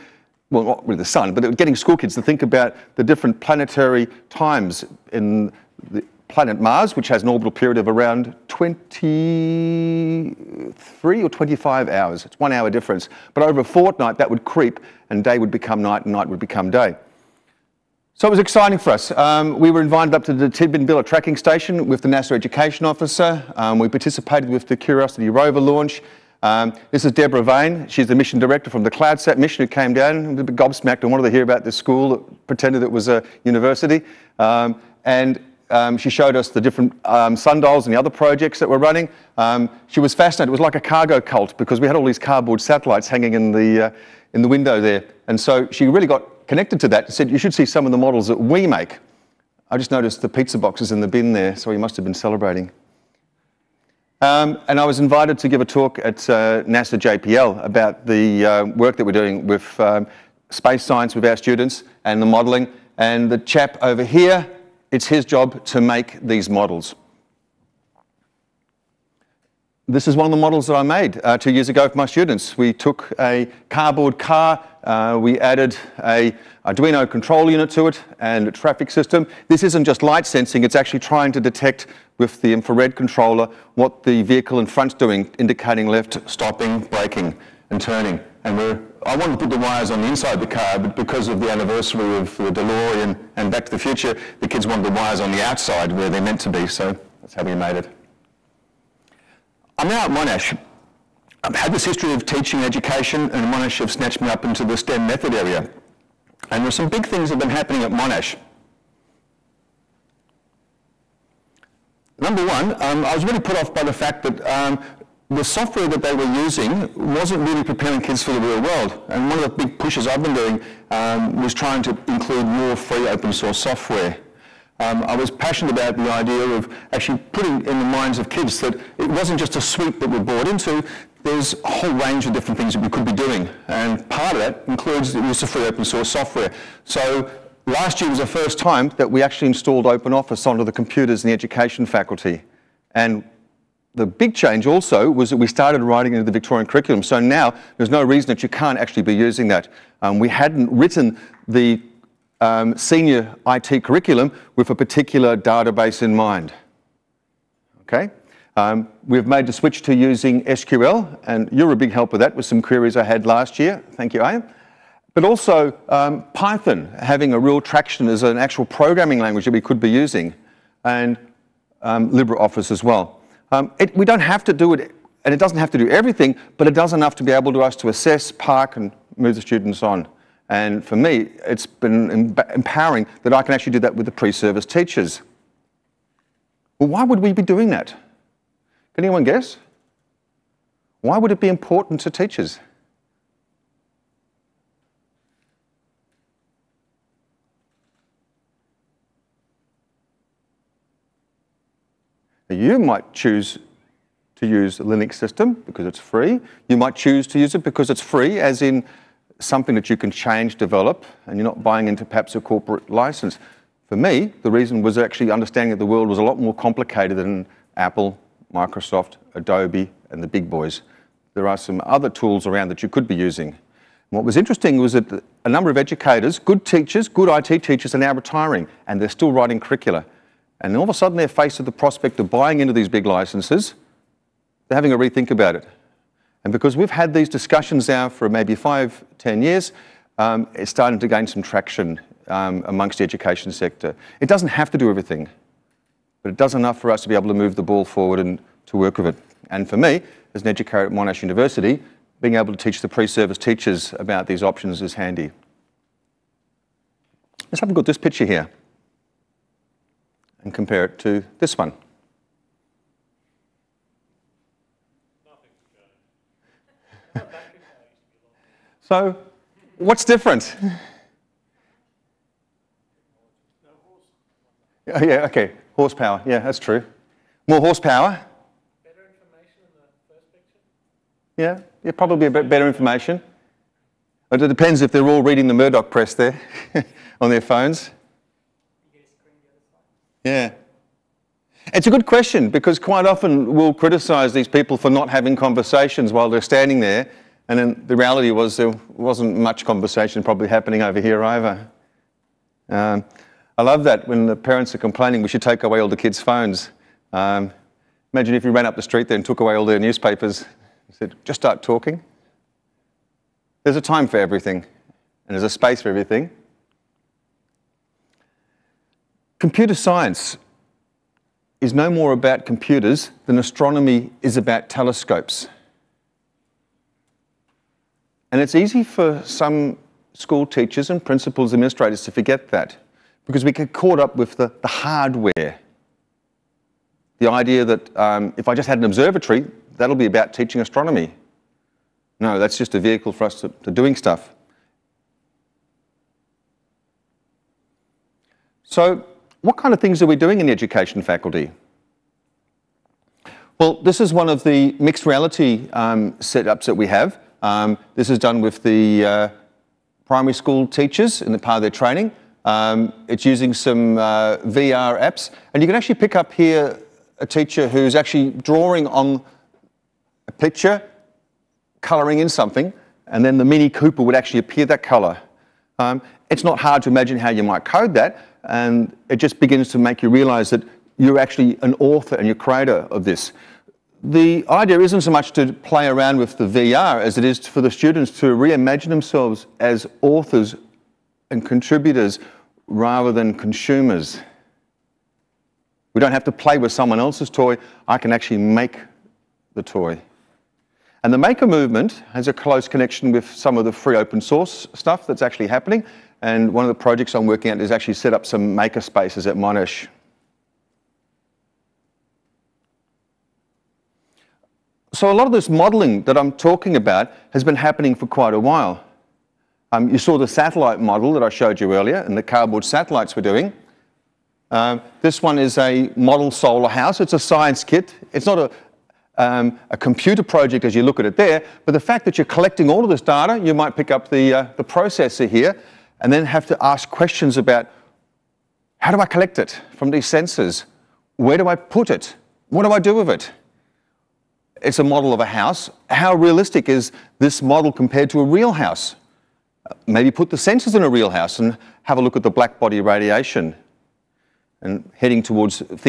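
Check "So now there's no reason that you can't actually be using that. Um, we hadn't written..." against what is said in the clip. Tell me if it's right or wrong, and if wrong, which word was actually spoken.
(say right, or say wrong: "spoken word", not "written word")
right.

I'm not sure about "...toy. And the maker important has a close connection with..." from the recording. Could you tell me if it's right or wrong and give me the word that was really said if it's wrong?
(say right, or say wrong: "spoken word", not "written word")
wrong: "movement", not "important".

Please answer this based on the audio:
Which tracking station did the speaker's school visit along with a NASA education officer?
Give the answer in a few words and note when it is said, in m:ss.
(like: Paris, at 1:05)
Tidbinbilla, at 0:20.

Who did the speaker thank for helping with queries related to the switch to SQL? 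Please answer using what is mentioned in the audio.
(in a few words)
Ian.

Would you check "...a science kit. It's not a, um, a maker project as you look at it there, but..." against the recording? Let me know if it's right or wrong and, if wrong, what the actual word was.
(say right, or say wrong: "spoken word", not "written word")
wrong: "computer", not "maker".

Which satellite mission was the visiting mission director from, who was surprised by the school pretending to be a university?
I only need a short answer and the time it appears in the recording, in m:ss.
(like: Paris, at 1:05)
CloudSat, at 0:28.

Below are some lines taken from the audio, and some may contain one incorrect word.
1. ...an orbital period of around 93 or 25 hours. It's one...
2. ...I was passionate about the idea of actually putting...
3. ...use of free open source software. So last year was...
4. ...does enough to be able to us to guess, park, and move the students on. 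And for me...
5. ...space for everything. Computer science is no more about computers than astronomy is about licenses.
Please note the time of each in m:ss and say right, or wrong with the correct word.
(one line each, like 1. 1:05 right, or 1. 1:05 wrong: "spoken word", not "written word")
1. 0:07 wrong: "23", not "93"
2. 2:05 right
3. 2:15 right
4. 2:56 wrong: "assess", not "guess"
5. 5:15 wrong: "telescopes", not "licenses".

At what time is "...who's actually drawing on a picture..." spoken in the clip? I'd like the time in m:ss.
6:07.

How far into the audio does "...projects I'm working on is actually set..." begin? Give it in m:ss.
6:46.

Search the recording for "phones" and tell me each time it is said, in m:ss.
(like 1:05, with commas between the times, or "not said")
4:47, 5:06.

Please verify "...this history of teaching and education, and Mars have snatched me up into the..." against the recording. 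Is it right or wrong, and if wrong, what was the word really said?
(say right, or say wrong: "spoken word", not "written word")
wrong: "Monash", not "Mars".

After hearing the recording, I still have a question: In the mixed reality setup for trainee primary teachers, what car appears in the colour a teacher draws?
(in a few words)
Mini Cooper.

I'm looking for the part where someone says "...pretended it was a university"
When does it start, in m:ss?
0:32.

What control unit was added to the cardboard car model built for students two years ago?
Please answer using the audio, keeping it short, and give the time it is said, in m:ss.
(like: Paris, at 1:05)
Arduino, at 1:16.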